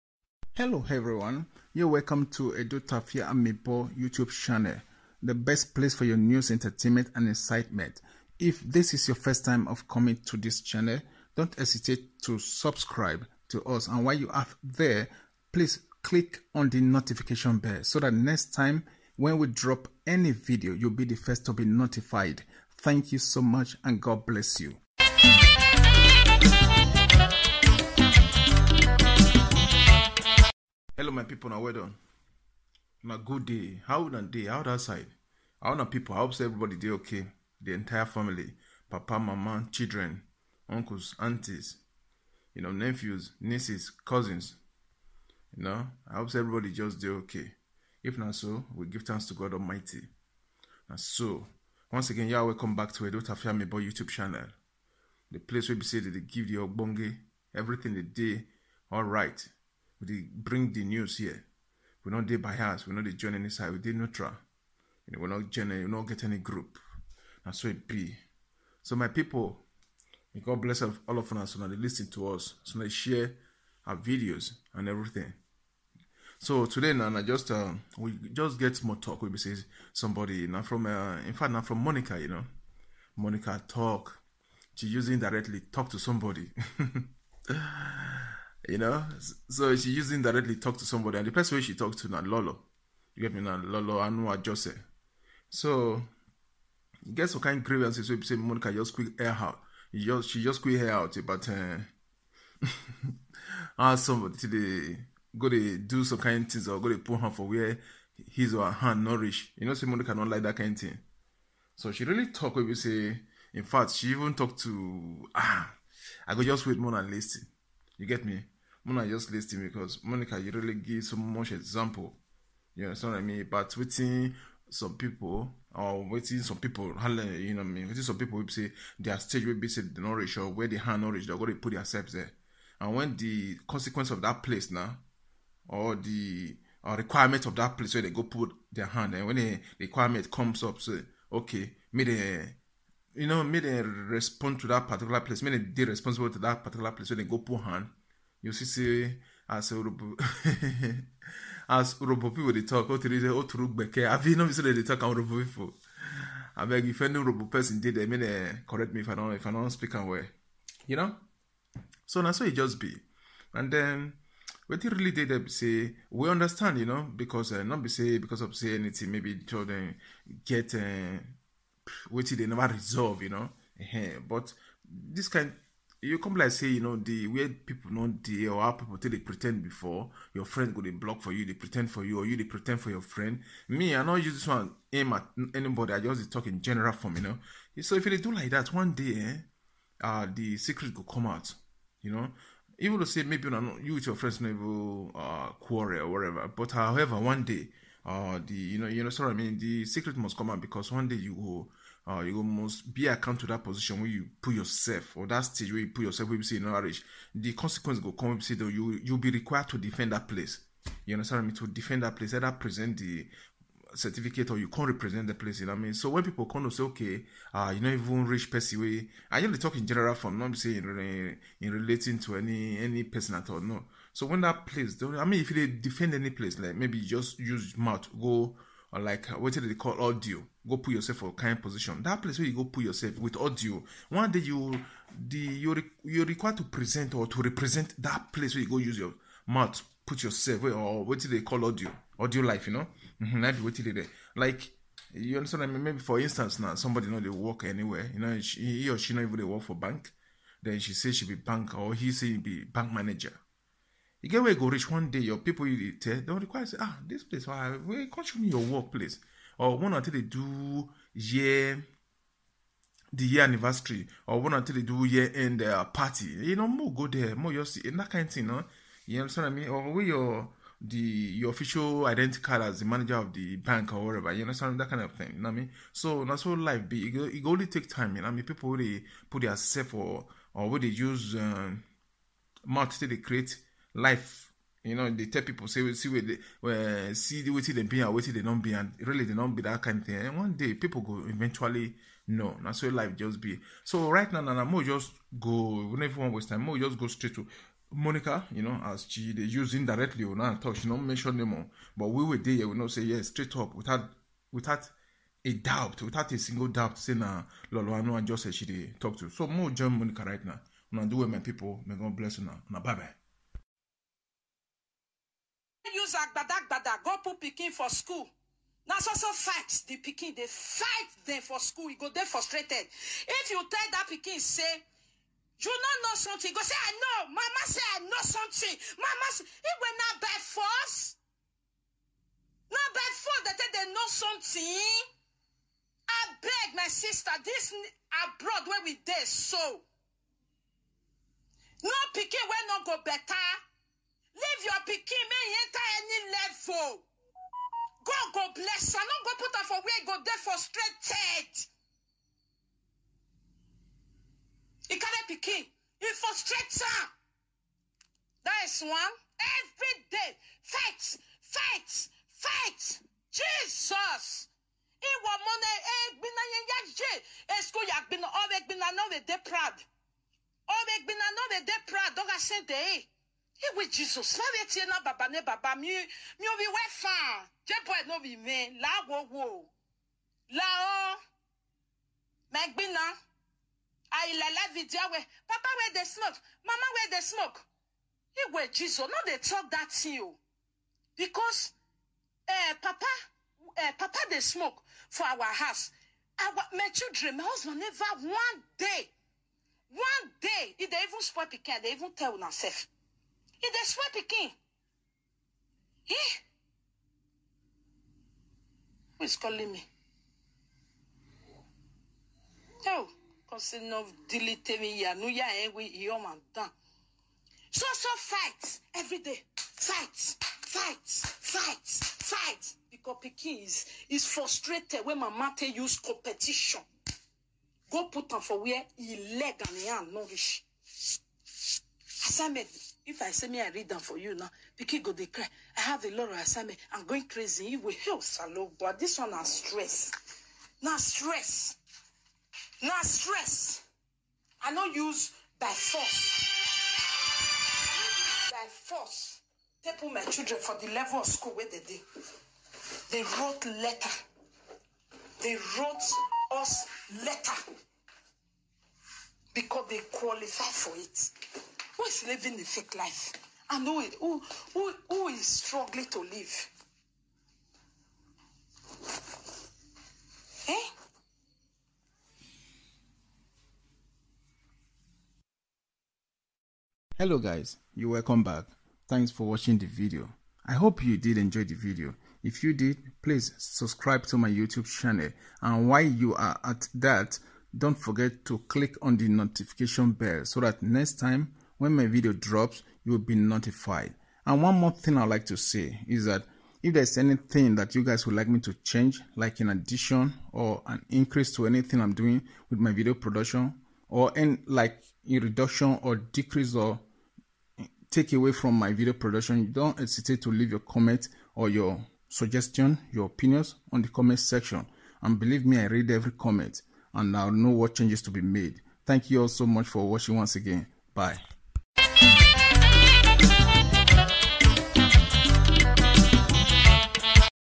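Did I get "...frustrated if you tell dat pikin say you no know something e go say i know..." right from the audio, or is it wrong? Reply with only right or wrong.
right.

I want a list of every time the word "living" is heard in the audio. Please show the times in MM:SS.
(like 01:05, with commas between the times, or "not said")
07:42.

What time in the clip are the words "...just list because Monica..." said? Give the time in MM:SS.
01:59.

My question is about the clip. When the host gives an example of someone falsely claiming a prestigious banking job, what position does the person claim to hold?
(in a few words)
bank manager.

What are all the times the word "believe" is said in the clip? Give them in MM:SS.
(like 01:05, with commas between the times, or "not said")
08:35.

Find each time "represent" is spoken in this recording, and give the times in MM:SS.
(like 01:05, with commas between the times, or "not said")
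03:34, 03:57.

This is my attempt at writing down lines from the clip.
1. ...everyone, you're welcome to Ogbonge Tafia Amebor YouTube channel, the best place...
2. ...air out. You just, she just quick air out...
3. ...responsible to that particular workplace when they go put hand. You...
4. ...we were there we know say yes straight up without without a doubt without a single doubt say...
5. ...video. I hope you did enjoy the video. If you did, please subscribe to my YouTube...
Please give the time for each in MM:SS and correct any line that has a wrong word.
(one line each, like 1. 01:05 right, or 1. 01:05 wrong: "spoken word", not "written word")
1. 00:00 wrong: "Edo", not "Ogbonge"
2. 01:39 right
3. 02:25 wrong: "place", not "workplace"
4. 05:02 right
5. 07:59 right.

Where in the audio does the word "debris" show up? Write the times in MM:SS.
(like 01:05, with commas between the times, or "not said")
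not said.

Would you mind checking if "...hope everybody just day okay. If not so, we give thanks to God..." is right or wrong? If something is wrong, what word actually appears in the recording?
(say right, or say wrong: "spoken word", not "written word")
right.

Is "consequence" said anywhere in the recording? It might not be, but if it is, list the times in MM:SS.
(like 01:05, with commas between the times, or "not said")
02:13, 03:27.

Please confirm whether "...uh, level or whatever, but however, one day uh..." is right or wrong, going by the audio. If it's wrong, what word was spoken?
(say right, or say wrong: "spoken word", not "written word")
wrong: "quarrel", not "level".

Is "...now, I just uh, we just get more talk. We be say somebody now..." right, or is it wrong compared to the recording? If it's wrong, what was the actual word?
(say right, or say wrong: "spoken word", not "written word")
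right.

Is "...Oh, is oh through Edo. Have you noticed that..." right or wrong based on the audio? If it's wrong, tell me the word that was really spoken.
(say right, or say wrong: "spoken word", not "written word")
wrong: "Beke", not "Edo".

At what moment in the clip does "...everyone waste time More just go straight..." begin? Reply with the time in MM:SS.
04:56.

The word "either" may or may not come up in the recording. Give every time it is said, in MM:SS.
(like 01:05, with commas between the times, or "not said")
03:32.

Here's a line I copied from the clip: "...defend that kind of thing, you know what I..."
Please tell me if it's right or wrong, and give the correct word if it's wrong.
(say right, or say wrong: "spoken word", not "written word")
wrong: "understand", not "defend".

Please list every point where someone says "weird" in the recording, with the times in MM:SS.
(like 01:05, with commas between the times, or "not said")
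02:57.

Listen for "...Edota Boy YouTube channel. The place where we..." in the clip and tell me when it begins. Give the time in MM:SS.
00:53.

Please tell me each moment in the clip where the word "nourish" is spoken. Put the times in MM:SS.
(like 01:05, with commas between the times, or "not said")
01:48, 07:09.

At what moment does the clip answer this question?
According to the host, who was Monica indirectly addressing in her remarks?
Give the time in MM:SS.
01:33.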